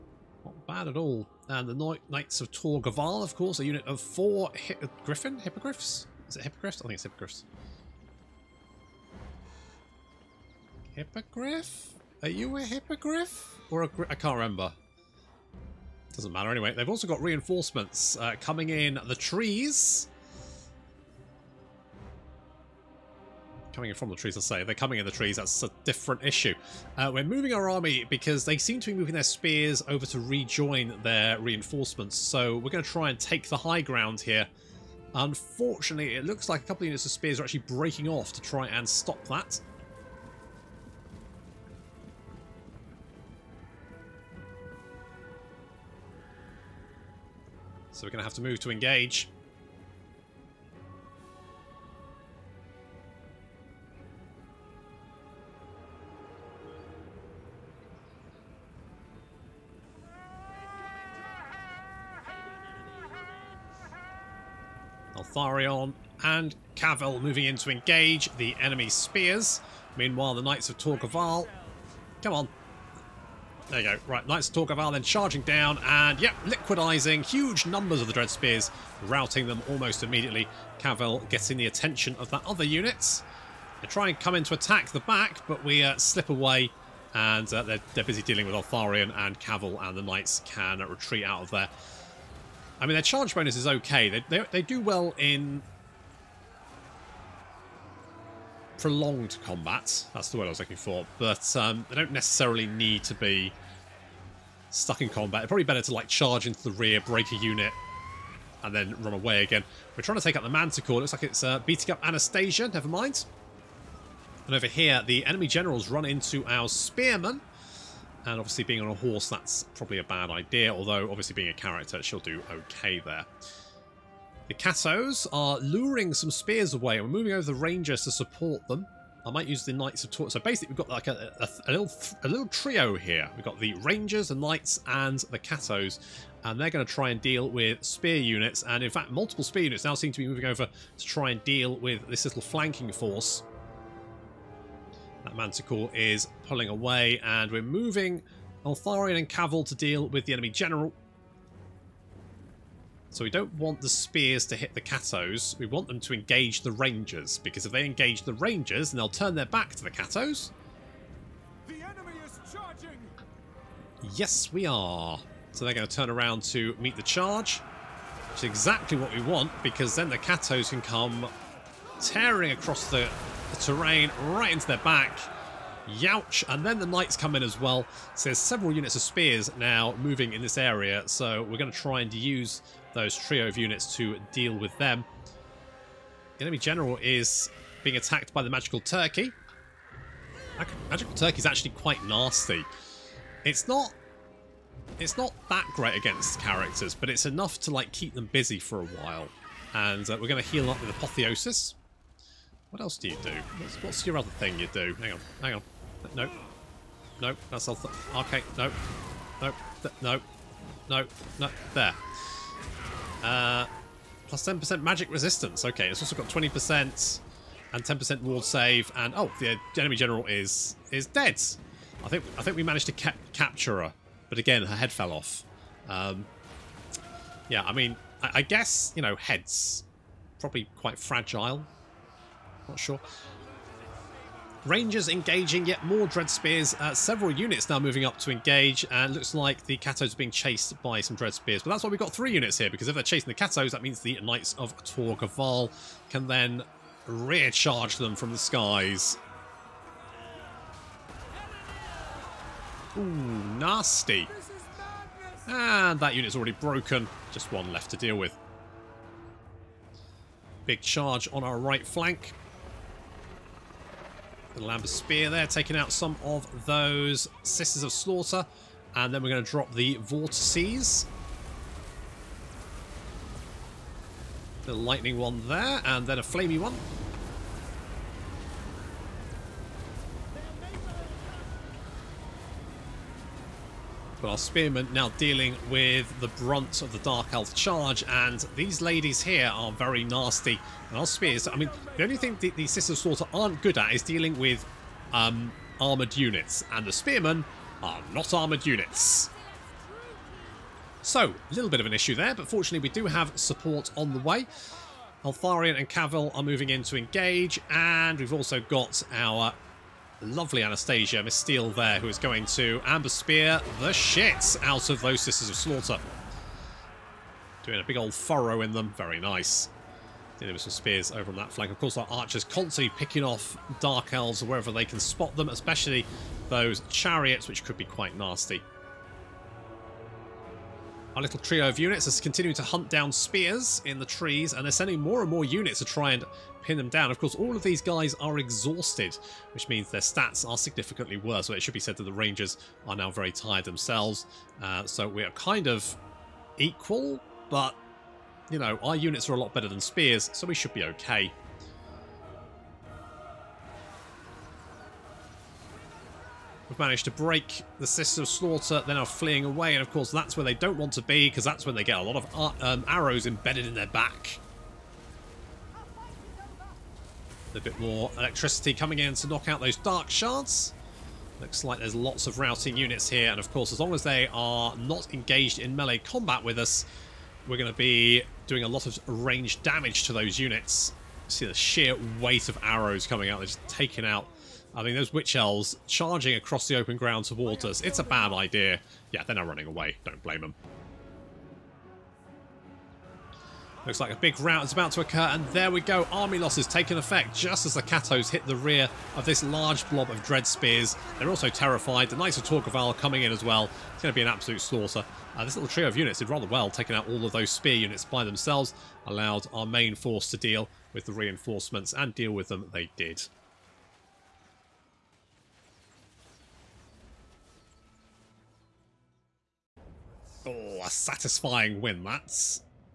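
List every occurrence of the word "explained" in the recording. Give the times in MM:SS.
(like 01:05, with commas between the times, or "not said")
not said.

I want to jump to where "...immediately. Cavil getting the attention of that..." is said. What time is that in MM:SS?
01:20.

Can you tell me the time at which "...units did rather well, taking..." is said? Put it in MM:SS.
06:45.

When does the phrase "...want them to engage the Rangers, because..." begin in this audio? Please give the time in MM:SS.
02:35.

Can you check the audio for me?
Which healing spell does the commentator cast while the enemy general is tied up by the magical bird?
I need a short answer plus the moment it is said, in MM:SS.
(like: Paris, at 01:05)
Apotheosis, at 03:20.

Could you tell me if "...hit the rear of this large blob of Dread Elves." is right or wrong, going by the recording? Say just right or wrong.
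wrong.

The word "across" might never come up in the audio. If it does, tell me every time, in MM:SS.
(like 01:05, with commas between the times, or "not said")
02:52, 06:26.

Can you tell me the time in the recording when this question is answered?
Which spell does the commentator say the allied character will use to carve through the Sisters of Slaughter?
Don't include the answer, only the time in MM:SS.
05:12.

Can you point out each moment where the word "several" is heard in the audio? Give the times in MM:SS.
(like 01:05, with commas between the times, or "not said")
02:58, 03:56.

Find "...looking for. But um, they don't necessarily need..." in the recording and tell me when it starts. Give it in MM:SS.
01:40.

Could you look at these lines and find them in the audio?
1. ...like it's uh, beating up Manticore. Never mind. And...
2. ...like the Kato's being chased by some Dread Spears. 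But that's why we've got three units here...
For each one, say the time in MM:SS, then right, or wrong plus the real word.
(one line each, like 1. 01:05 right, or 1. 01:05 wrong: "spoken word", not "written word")
1. 01:51 wrong: "Anastasia", not "Manticore"
2. 03:59 right.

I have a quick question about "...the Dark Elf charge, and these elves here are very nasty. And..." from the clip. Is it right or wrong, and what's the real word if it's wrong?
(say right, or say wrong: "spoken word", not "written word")
wrong: "ladies", not "elves".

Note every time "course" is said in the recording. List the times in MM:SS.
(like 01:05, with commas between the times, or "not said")
00:03, 05:21, 05:37, 05:59, 06:13.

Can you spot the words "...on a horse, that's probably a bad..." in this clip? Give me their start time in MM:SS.
01:58.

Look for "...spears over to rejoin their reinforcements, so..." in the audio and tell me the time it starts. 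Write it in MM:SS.
00:29.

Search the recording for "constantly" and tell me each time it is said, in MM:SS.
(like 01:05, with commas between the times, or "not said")
05:22.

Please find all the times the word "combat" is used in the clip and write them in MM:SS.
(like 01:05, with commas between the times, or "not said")
01:39, 01:45, 06:15.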